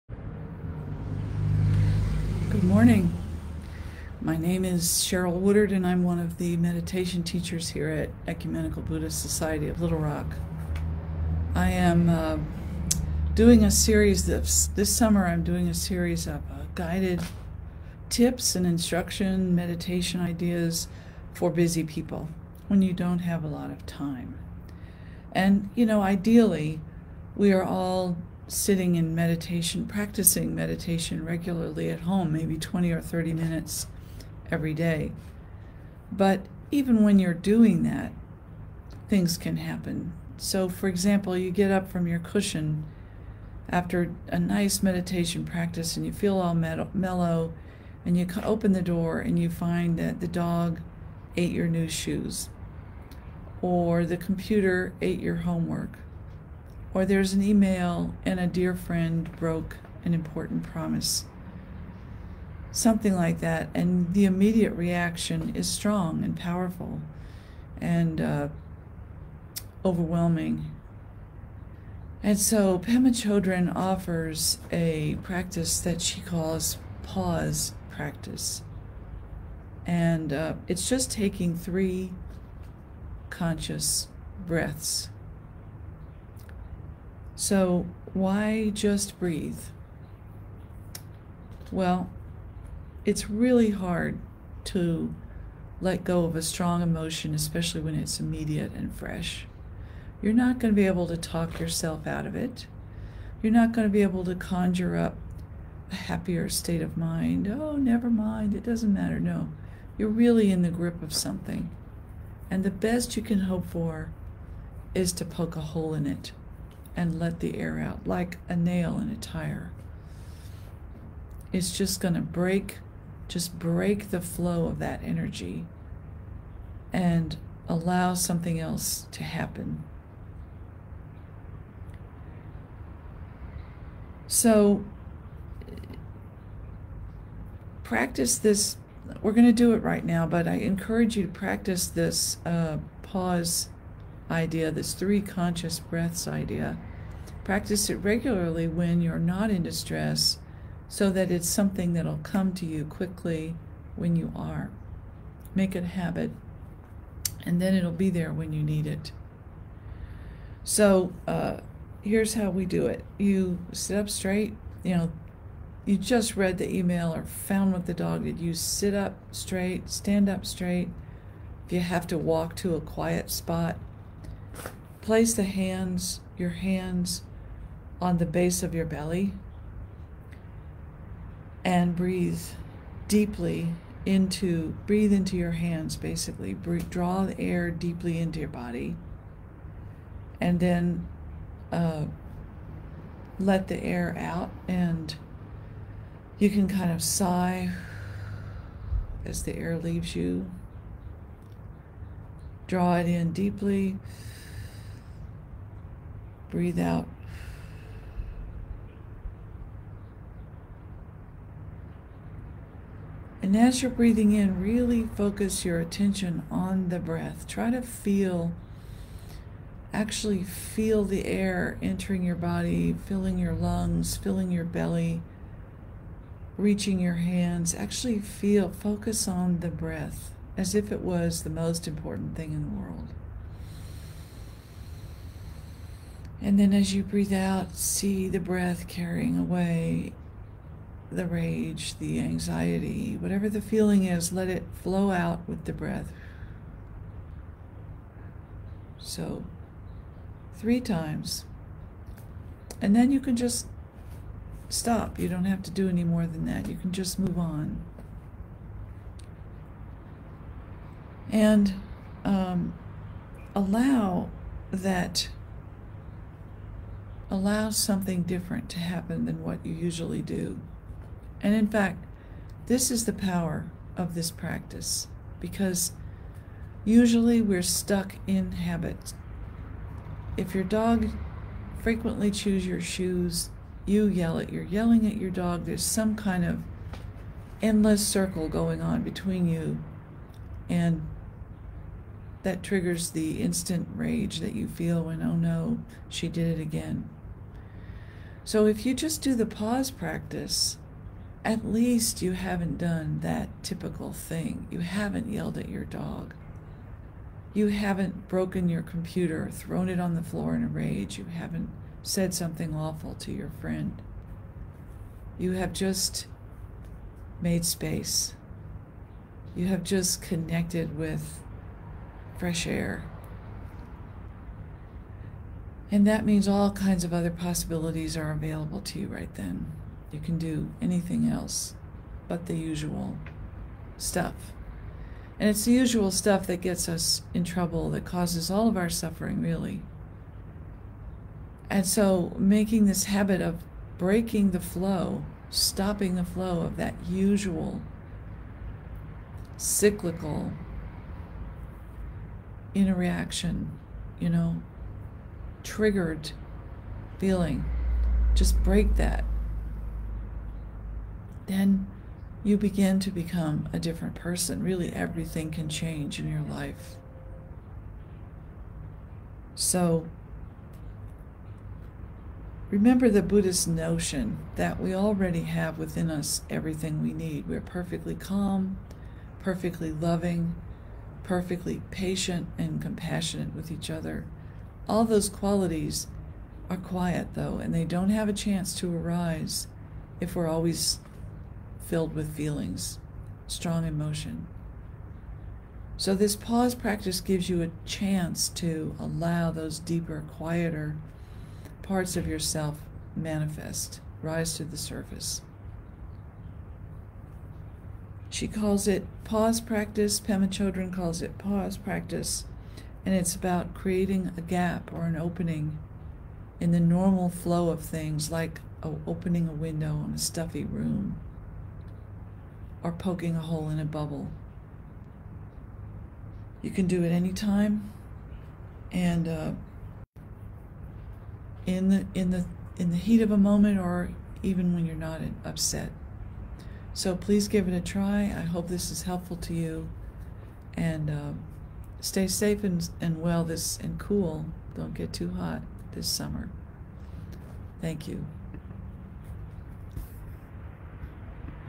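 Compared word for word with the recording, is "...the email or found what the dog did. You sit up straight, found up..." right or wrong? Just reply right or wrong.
wrong.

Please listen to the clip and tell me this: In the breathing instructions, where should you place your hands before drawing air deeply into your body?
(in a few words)
Base of your belly.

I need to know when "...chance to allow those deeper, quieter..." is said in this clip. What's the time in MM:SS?
06:37.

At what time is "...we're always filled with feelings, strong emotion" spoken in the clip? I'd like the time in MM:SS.
06:30.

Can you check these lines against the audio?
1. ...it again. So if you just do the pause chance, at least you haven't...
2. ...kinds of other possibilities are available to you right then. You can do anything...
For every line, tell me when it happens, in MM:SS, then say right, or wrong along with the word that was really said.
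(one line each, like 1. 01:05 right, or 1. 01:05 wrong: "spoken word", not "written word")
1. 04:56 wrong: "practice", not "chance"
2. 05:26 right.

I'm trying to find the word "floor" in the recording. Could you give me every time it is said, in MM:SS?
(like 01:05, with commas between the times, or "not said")
05:10.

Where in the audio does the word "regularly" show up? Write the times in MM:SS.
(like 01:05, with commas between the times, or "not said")
00:31, 02:27.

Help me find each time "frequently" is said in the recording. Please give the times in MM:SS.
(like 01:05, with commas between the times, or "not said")
04:41.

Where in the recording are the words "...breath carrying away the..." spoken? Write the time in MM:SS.
03:58.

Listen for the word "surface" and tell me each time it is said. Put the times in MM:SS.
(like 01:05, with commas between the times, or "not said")
06:44.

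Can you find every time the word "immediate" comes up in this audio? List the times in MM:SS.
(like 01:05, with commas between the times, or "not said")
01:04, 01:38.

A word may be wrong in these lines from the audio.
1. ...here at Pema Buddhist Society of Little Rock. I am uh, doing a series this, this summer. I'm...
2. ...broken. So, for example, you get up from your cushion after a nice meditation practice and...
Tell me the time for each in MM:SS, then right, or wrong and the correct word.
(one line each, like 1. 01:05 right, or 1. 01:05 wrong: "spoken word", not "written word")
1. 00:07 wrong: "Ecumenical", not "Pema"
2. 00:39 wrong: "happen", not "broken".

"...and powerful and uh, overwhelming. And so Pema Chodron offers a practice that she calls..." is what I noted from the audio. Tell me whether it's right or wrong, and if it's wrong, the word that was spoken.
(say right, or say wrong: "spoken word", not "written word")
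right.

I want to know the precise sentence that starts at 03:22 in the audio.
Draw it in deeply breathe out.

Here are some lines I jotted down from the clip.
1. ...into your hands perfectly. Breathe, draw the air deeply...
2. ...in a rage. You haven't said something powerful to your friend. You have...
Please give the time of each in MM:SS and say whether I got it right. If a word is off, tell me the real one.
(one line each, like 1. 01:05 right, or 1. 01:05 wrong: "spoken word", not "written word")
1. 03:05 wrong: "basically", not "perfectly"
2. 05:10 wrong: "awful", not "powerful".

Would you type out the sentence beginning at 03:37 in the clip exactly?
Try to feel, actually feel the air entering your body, filling your lungs, filling your belly, reaching your hands.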